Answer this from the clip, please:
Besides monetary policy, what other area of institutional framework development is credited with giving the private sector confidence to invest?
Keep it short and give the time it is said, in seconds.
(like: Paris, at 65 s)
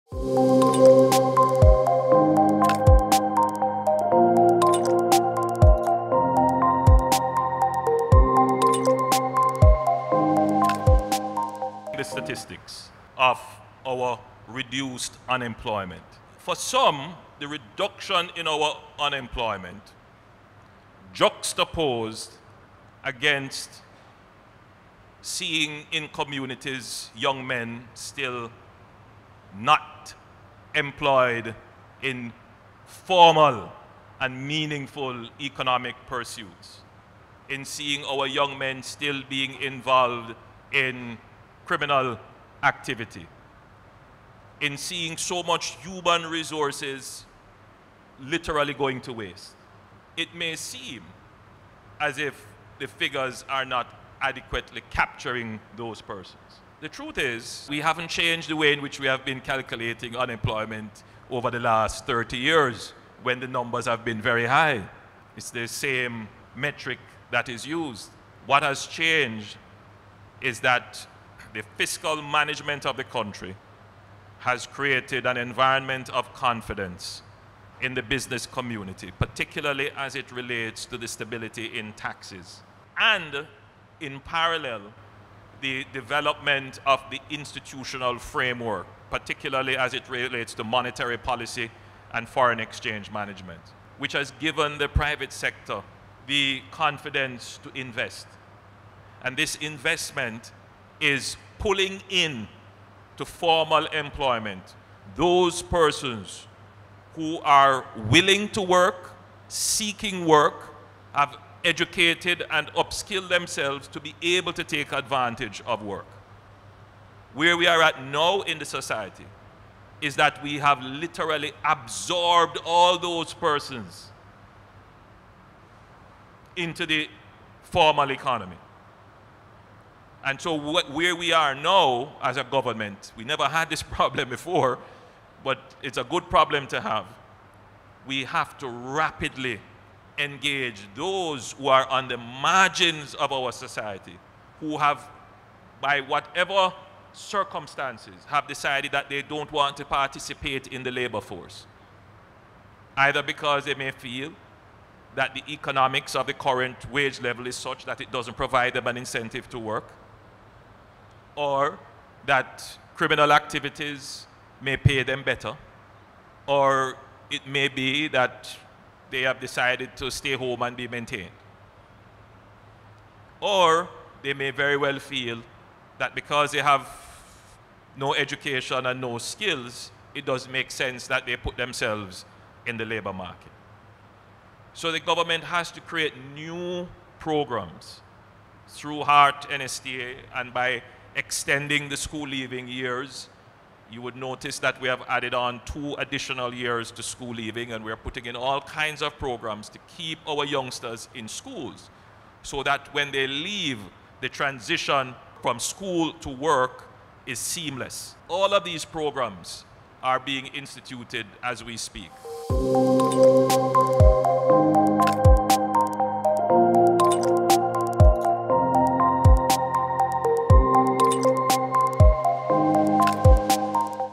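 Foreign exchange management, at 92 s.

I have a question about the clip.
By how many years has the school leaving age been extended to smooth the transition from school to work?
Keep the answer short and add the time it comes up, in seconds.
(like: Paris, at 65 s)
2, at 195 s.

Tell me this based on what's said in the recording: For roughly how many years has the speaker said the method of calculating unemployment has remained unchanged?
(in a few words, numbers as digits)
30 years.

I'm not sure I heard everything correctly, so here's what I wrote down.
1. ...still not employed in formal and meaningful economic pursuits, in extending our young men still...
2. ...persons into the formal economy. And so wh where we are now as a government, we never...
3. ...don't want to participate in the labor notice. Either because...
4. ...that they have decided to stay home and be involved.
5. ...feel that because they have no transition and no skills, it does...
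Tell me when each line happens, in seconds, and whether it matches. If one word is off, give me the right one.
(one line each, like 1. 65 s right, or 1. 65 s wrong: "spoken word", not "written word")
1. 27 s wrong: "seeing", not "extending"
2. 123 s right
3. 149 s wrong: "force", not "notice"
4. 168 s wrong: "maintained", not "involved"
5. 174 s wrong: "education", not "transition".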